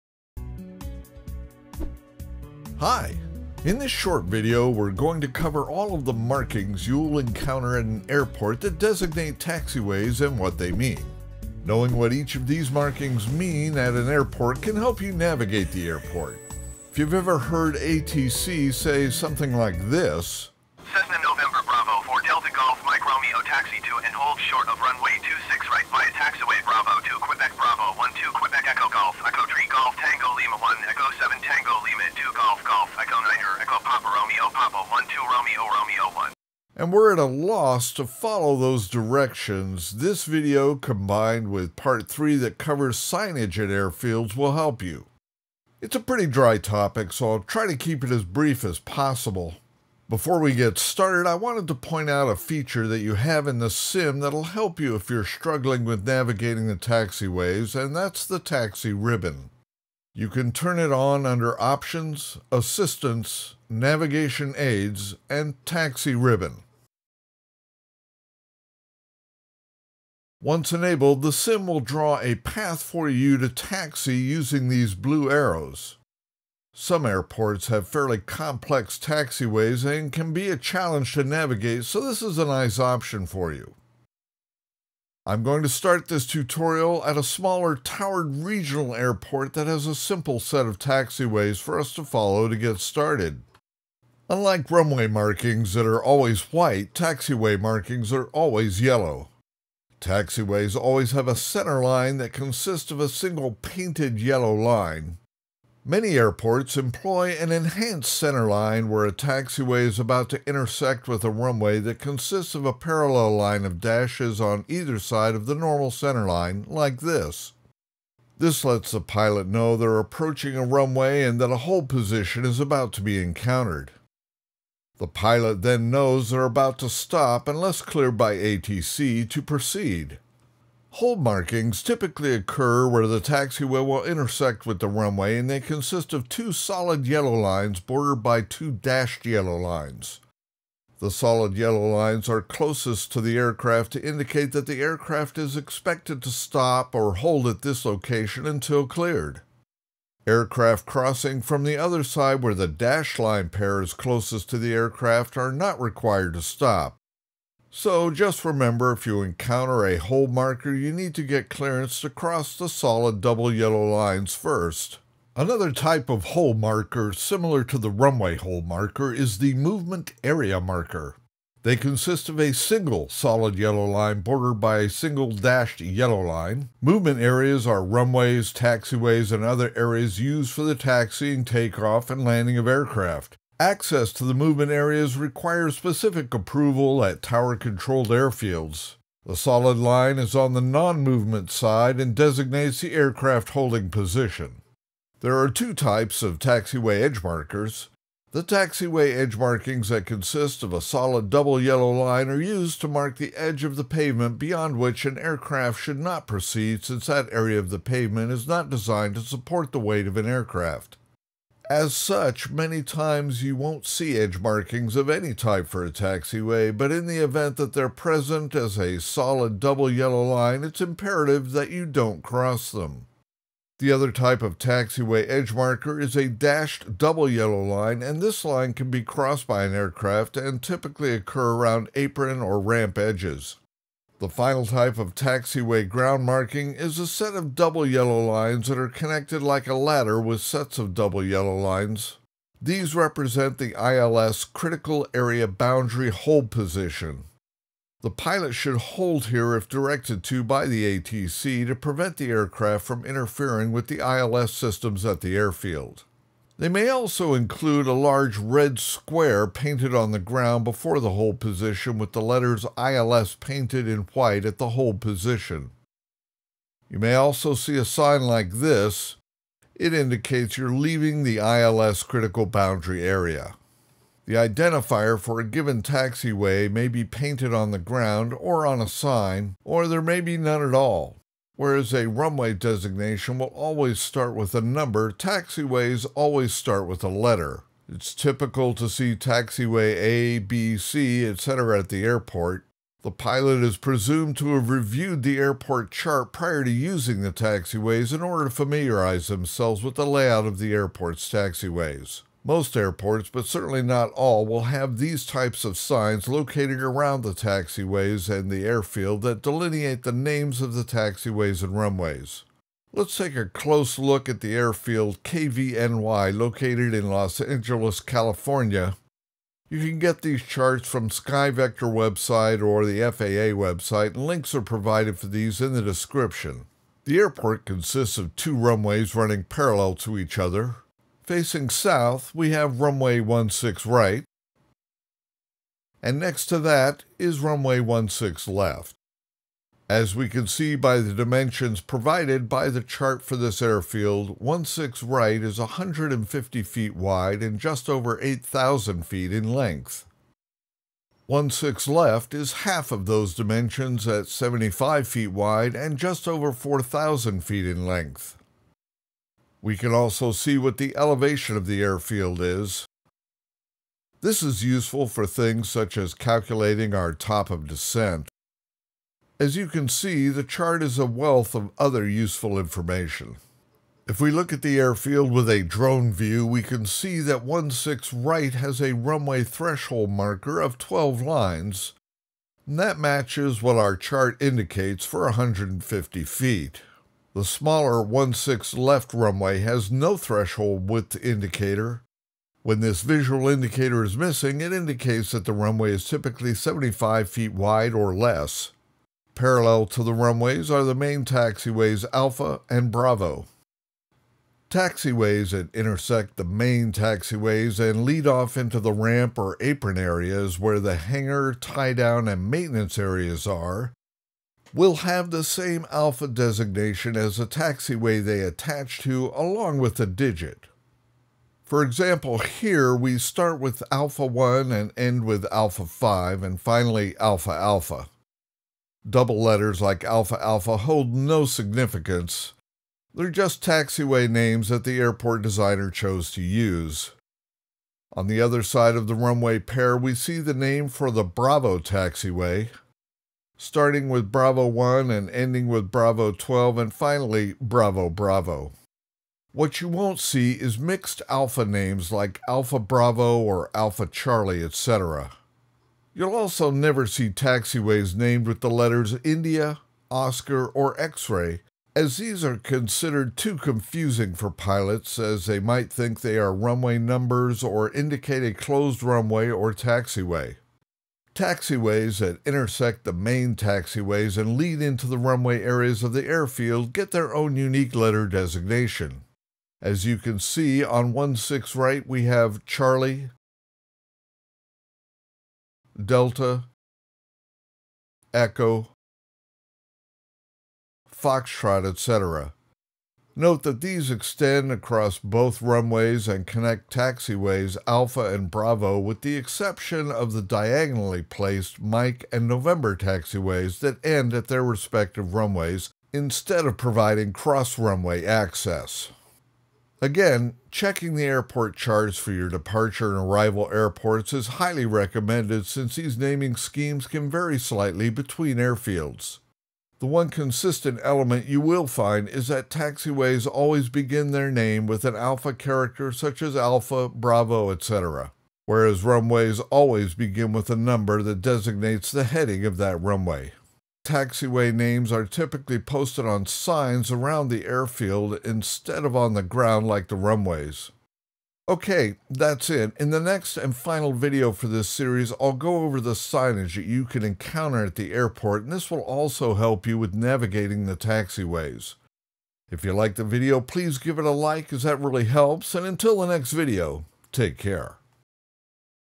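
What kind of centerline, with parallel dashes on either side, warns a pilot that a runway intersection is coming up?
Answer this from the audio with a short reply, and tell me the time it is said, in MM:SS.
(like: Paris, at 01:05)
Enhanced centerline, at 01:47.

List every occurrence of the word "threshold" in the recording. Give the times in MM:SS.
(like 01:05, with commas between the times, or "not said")
06:19, 06:30.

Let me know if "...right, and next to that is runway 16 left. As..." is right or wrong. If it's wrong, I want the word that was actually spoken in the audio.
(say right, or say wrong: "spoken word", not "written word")
right.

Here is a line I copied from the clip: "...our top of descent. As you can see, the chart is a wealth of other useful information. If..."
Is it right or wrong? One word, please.
right.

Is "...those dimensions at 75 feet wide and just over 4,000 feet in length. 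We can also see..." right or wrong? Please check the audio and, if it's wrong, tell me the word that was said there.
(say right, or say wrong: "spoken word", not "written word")
right.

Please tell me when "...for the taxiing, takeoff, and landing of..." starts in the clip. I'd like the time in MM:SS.
03:00.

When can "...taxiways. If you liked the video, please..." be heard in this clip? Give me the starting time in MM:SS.
09:10.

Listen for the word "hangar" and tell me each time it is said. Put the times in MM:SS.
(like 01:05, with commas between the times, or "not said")
06:50.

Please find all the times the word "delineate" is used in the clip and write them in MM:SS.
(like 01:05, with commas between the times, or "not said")
05:09.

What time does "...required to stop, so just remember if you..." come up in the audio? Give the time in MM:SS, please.
02:35.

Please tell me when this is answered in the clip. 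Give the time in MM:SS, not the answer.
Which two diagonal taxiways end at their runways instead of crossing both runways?
08:21.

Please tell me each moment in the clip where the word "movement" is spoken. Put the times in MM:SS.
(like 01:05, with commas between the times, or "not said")
02:49, 02:56, 03:04, 03:11.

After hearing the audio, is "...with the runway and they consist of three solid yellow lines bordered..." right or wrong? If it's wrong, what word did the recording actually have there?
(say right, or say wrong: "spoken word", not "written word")
wrong: "two", not "three".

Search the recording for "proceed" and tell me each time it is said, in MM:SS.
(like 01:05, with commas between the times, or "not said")
02:09, 03:26.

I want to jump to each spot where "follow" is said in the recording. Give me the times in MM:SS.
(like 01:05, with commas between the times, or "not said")
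00:38, 01:32.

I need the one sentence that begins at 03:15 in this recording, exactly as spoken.
There are two types of taxiway edge markers.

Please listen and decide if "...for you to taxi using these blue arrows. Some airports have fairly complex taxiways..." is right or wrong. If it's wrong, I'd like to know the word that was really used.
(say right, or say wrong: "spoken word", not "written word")
right.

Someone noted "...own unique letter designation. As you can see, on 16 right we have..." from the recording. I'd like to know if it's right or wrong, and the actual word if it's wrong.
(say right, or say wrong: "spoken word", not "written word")
right.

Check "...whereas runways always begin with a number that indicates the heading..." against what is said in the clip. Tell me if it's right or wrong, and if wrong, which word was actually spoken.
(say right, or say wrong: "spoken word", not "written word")
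wrong: "designates", not "indicates".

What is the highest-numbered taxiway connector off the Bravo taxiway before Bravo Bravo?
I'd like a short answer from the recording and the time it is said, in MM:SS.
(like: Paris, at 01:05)
Bravo 12, at 07:25.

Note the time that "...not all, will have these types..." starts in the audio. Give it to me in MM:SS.
05:03.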